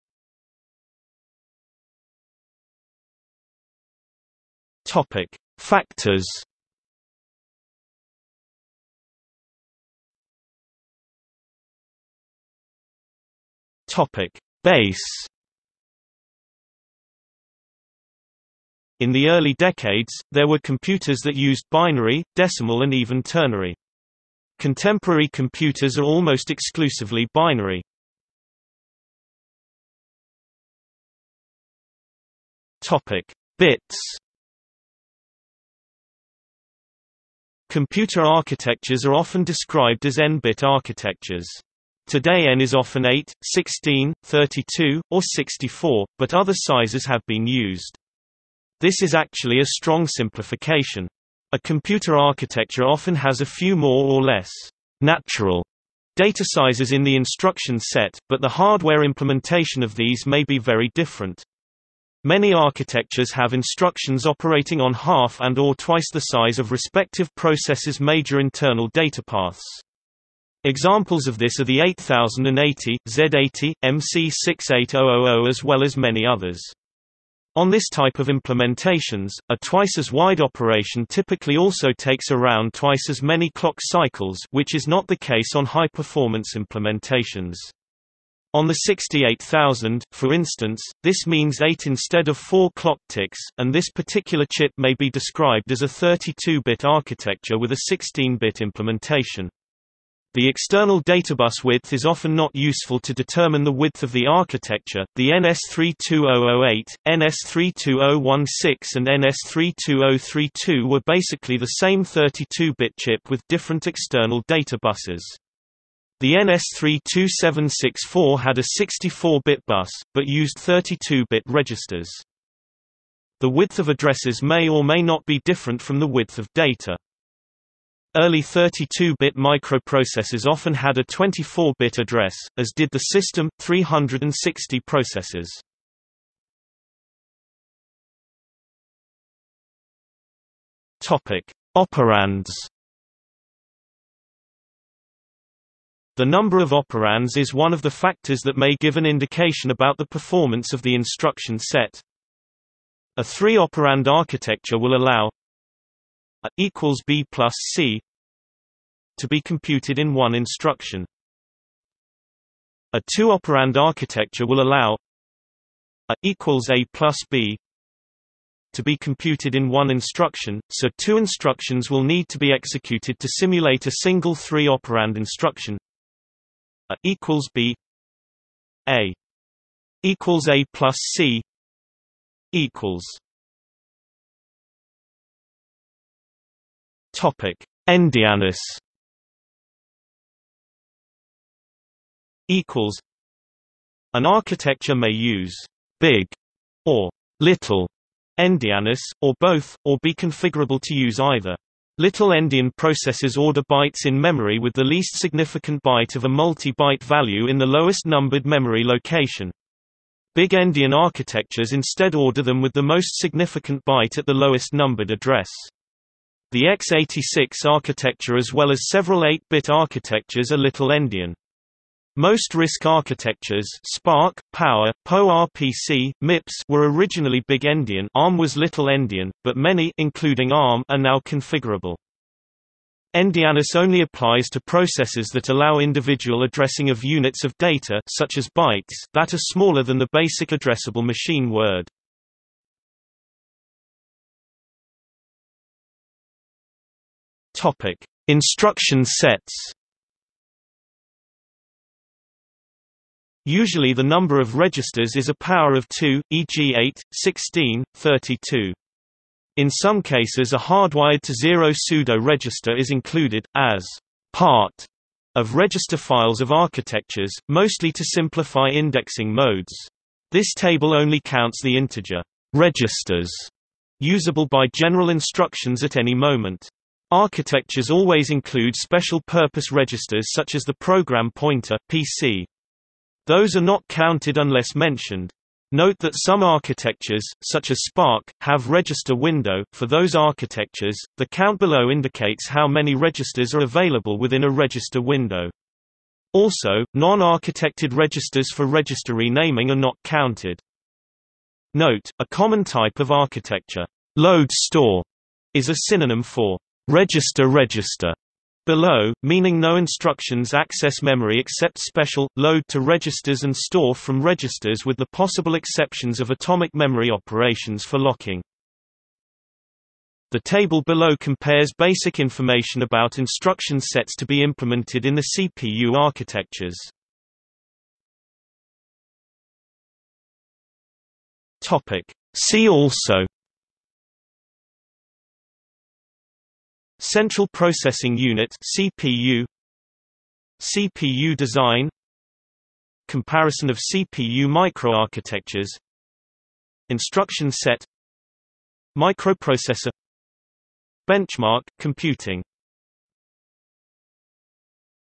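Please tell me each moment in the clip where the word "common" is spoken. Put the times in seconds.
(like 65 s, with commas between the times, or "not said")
302 s.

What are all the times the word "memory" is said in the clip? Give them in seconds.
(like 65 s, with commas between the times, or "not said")
204 s, 208 s, 311 s, 316 s.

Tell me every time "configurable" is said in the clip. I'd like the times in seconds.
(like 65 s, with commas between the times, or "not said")
200 s, 231 s.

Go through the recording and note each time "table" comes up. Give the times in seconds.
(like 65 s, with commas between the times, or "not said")
270 s, 320 s.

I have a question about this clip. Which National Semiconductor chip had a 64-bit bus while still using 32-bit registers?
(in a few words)
NS32764.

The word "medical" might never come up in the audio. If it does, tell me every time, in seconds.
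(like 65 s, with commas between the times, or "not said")
not said.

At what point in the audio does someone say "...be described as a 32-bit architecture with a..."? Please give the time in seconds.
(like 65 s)
94 s.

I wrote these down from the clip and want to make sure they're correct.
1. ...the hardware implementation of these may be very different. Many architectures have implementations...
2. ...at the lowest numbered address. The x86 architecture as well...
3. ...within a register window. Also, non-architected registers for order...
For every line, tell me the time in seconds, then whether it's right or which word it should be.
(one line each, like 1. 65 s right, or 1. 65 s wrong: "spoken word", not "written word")
1. 58 s wrong: "instructions", not "implementations"
2. 214 s right
3. 294 s wrong: "register", not "order".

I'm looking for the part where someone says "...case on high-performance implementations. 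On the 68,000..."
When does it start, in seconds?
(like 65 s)
85 s.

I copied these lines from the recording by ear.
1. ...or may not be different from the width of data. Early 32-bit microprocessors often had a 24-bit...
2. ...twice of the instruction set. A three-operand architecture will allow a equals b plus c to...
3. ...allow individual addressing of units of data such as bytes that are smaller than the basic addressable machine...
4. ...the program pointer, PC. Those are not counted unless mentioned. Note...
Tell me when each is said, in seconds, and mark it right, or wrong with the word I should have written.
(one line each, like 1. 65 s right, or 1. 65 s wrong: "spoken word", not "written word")
1. 124 s right
2. 150 s wrong: "performance", not "twice"
3. 235 s right
4. 280 s right.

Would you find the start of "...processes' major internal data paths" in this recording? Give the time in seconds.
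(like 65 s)
67 s.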